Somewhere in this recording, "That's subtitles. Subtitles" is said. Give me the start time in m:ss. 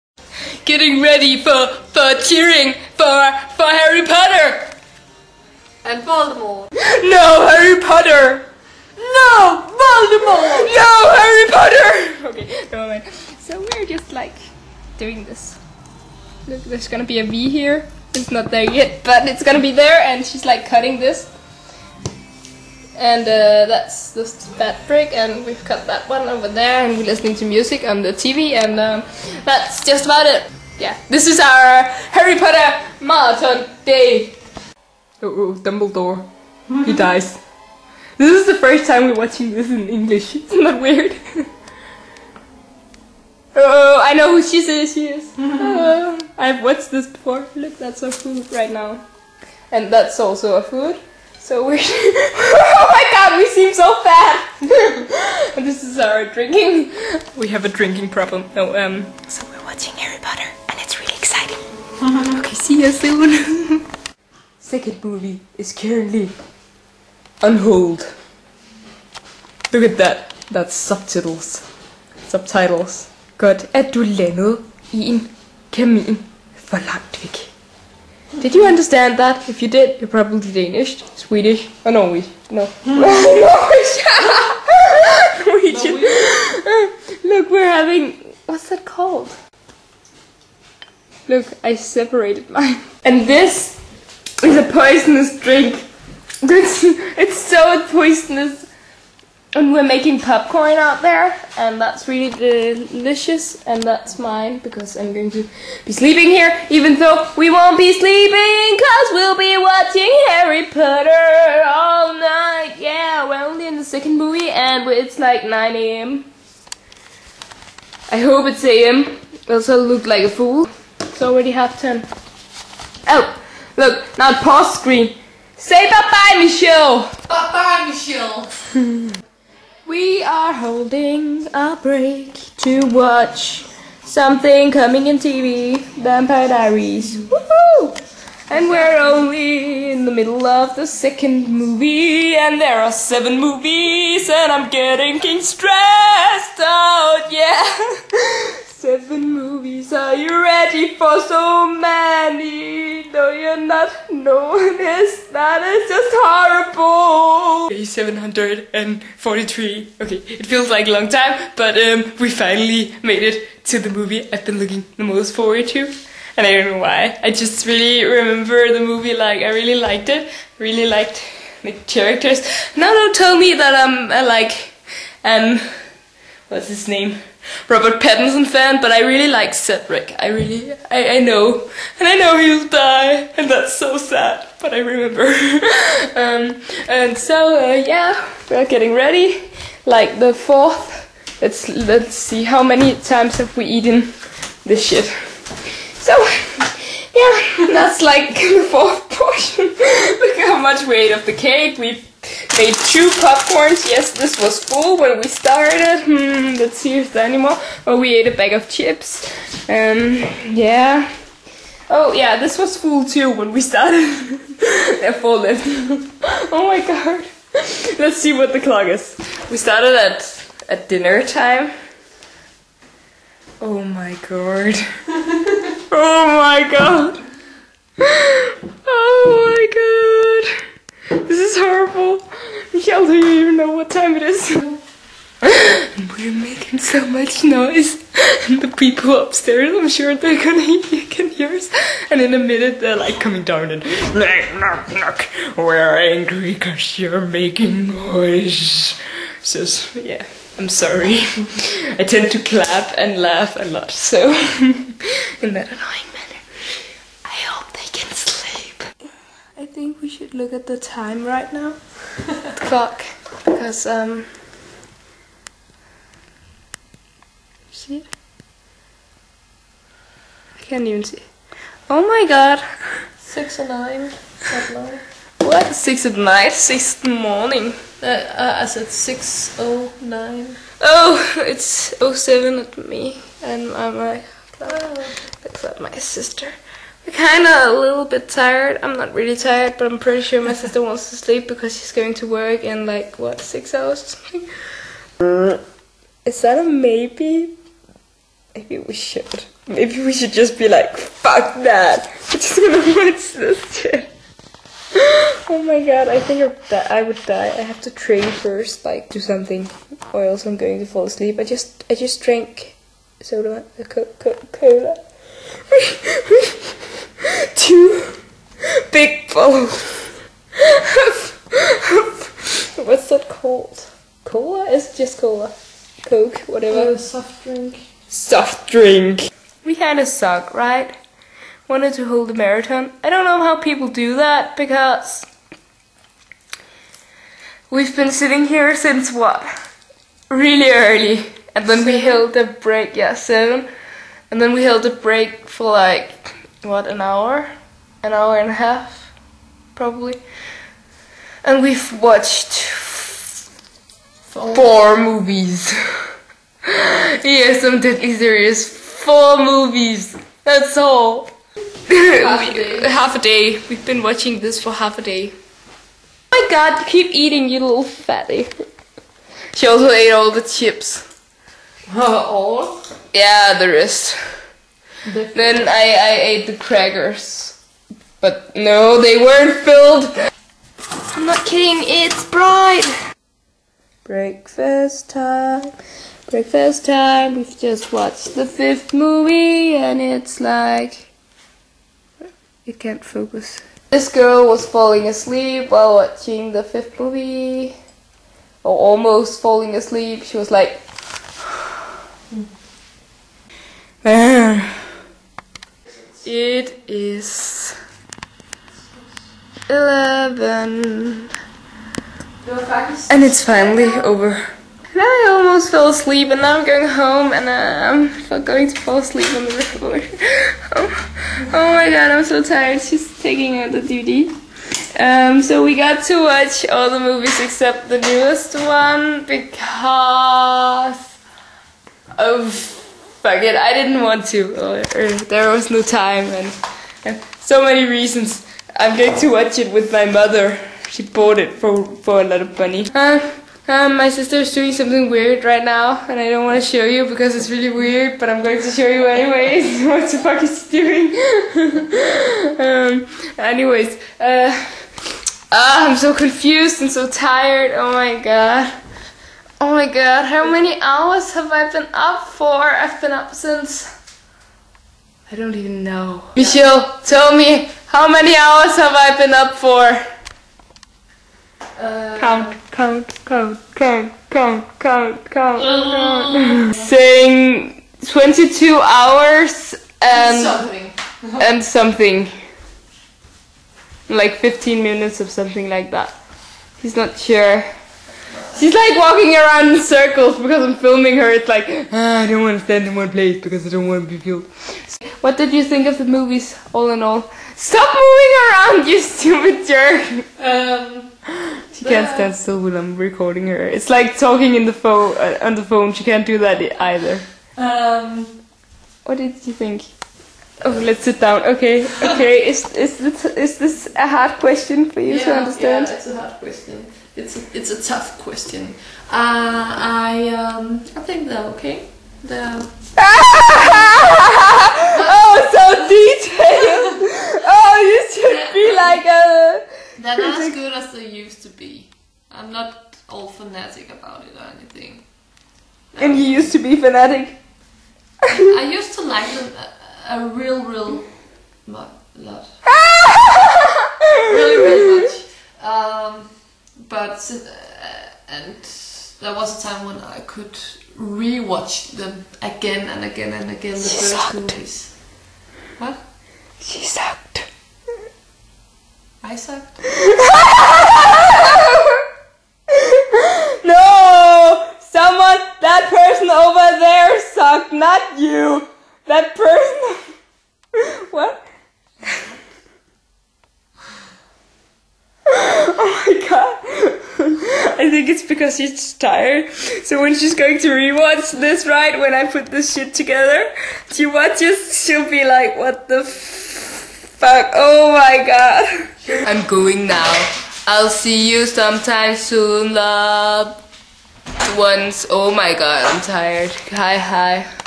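1:10.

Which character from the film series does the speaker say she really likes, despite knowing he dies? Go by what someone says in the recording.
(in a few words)
Cedric.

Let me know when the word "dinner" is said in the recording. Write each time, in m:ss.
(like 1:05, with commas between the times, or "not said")
3:40.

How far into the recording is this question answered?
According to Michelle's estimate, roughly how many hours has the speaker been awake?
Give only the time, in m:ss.
7:58.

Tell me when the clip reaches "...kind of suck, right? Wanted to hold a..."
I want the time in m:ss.
5:29.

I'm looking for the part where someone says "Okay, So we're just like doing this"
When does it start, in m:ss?
0:12.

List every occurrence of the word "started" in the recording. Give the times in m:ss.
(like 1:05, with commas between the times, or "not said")
3:25, 3:33, 3:39.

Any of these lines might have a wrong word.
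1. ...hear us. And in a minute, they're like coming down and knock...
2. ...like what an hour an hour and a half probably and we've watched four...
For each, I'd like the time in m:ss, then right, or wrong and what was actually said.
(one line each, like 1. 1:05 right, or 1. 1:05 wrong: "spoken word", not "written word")
1. 4:01 right
2. 5:45 right.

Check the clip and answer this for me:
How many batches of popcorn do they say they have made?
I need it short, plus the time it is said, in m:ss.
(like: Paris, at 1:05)
2, at 3:22.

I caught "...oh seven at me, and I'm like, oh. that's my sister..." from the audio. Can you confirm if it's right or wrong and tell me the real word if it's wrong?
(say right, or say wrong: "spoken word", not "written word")
right.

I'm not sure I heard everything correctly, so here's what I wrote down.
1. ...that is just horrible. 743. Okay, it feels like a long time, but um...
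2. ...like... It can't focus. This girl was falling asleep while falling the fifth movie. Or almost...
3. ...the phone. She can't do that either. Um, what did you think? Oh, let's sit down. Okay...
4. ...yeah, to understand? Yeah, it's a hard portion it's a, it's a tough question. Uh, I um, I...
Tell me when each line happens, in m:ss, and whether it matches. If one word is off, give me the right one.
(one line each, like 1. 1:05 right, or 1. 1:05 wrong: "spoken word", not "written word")
1. 2:35 right
2. 6:30 wrong: "watching", not "falling"
3. 8:25 right
4. 8:35 wrong: "question", not "portion".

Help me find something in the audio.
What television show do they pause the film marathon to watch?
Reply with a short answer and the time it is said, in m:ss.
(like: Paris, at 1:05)
Vampire Diaries, at 2:16.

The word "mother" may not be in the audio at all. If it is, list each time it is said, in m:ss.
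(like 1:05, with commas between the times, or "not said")
7:20.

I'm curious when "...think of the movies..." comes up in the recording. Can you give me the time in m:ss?
8:15.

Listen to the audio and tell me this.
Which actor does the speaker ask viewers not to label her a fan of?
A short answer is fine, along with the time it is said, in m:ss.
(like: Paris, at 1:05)
Robert Pattinson, at 2:57.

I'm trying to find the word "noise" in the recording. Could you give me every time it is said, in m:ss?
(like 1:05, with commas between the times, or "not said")
3:57, 4:07.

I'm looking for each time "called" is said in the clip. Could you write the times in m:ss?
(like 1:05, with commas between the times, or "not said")
1:28, 5:23.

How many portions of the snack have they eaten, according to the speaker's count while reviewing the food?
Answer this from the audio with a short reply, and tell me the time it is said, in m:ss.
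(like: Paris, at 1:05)
4, at 3:18.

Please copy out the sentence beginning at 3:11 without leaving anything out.
Let's, let's see, how many times have we eaten this shit?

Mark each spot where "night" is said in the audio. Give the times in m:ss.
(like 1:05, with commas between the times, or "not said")
1:52, 4:36.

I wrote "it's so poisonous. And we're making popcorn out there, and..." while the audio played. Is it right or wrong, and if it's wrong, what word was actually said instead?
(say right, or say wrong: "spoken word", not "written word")
right.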